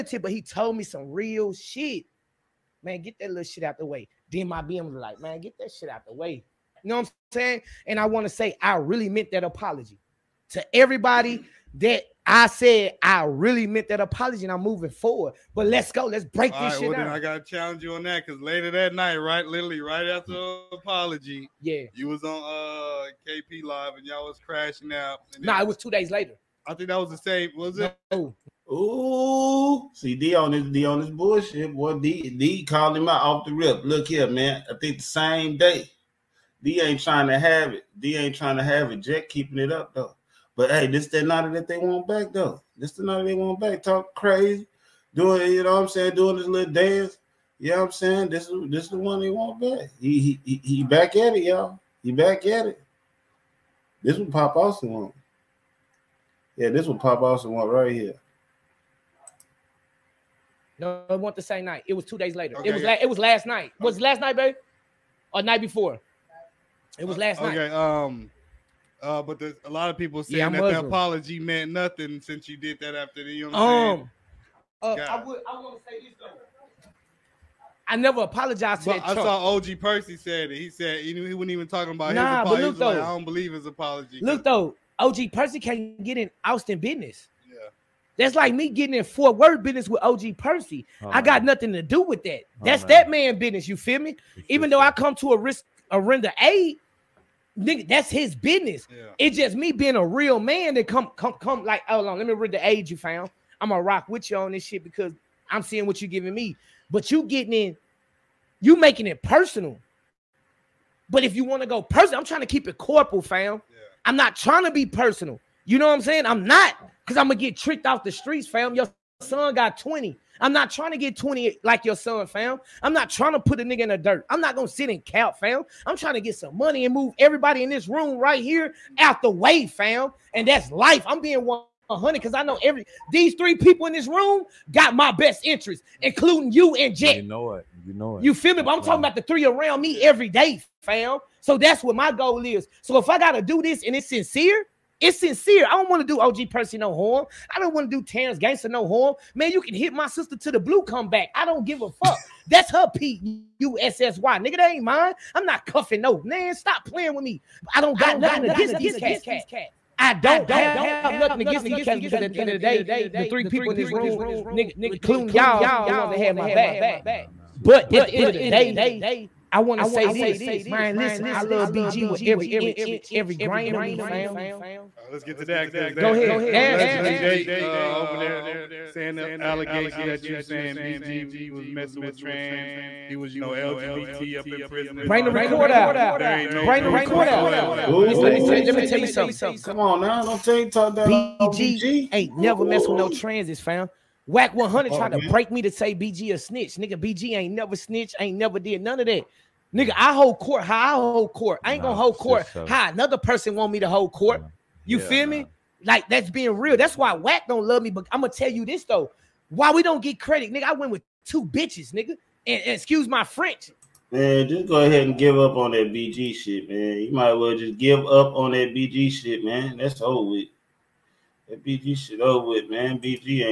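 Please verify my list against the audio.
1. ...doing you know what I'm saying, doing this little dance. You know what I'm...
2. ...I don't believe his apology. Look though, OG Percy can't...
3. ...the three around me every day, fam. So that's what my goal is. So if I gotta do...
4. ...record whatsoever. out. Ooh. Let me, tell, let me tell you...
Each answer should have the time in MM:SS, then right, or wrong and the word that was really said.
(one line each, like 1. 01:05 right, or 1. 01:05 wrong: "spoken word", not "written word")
1. 00:45 right
2. 01:22 right
3. 02:19 right
4. 03:06 right.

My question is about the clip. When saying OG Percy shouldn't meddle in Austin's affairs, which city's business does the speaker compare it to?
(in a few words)
Fort Worth.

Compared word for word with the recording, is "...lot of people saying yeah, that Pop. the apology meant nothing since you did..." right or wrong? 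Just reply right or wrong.
wrong.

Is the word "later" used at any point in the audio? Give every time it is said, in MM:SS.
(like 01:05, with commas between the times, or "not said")
00:18, 00:26, 01:02.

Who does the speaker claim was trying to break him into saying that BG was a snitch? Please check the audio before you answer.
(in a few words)
Wack 100.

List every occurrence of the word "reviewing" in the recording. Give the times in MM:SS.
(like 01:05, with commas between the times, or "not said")
not said.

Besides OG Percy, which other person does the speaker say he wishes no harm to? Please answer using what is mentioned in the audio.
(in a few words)
Terrence Gangster.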